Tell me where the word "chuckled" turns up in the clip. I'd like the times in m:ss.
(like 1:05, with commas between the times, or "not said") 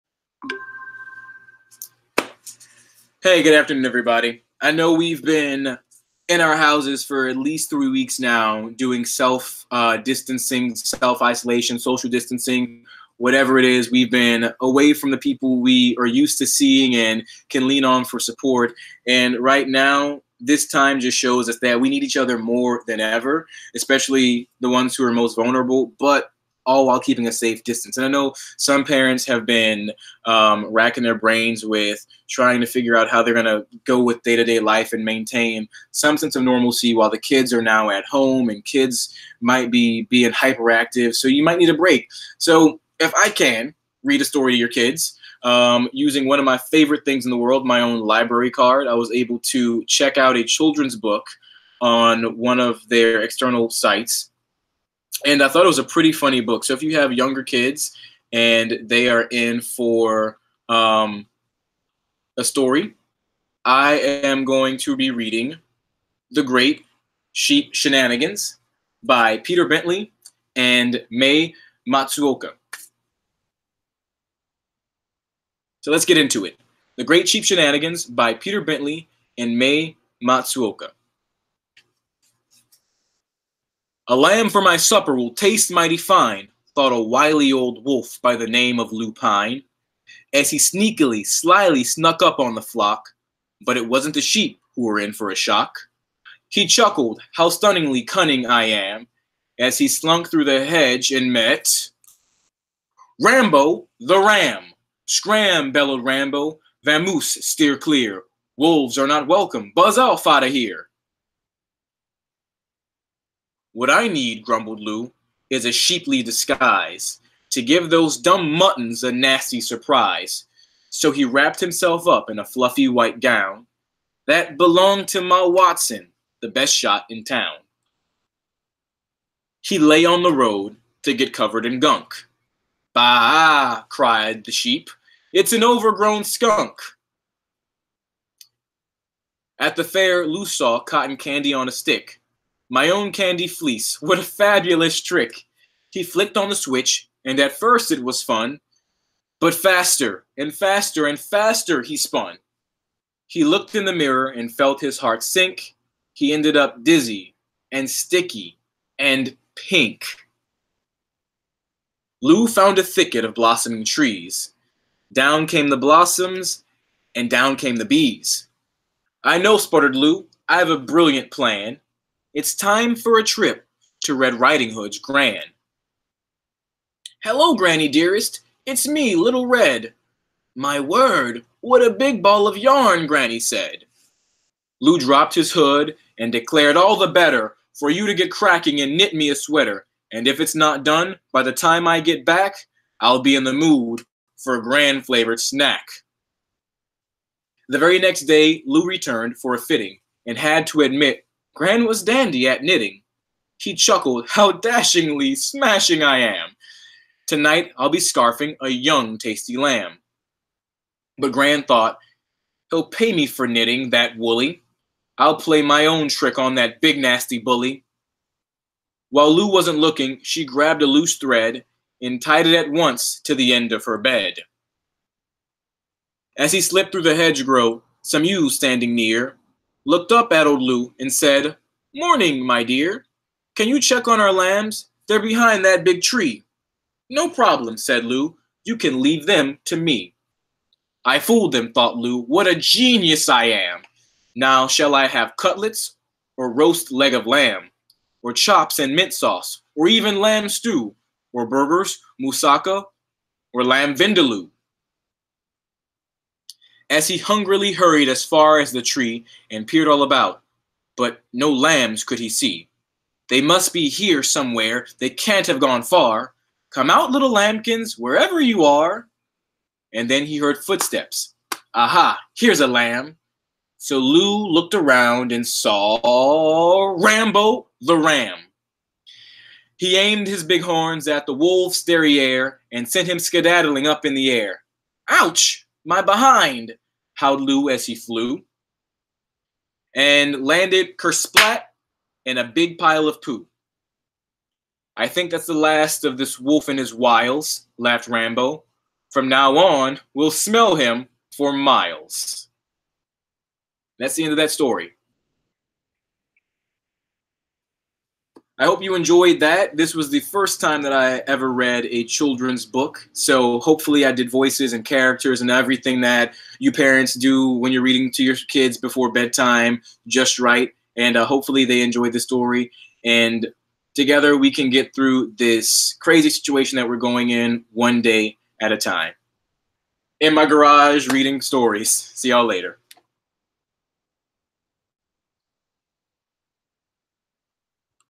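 1:36, 3:23.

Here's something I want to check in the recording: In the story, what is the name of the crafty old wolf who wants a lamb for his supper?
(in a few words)
Lupine.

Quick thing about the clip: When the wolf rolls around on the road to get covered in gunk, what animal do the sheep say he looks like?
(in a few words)
An overgrown skunk.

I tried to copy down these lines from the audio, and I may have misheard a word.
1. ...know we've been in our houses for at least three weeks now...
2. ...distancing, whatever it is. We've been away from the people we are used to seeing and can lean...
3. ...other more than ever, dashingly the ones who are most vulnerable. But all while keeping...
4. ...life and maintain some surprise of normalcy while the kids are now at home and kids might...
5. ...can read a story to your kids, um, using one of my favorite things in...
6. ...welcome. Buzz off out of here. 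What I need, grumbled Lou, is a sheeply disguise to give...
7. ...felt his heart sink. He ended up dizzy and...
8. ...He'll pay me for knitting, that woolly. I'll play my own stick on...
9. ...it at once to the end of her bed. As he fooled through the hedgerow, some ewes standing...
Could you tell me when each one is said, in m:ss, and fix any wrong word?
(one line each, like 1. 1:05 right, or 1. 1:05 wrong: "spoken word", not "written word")
1. 0:04 right
2. 0:12 right
3. 0:22 wrong: "especially", not "dashingly"
4. 0:34 wrong: "sense", not "surprise"
5. 0:43 right
6. 1:49 right
7. 2:34 right
8. 3:32 wrong: "trick", not "stick"
9. 3:42 wrong: "slipped", not "fooled".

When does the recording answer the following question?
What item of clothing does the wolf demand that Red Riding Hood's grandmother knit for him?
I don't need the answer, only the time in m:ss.
3:09.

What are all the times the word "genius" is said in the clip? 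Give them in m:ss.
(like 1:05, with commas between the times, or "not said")
4:02.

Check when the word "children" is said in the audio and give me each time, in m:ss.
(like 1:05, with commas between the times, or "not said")
0:50, 5:12.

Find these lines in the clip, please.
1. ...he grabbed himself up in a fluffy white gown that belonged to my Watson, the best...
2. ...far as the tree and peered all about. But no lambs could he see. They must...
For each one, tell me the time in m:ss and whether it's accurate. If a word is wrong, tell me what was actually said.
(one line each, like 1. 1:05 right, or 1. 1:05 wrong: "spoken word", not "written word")
1. 2:01 wrong: "wrapped", not "grabbed"
2. 4:18 right.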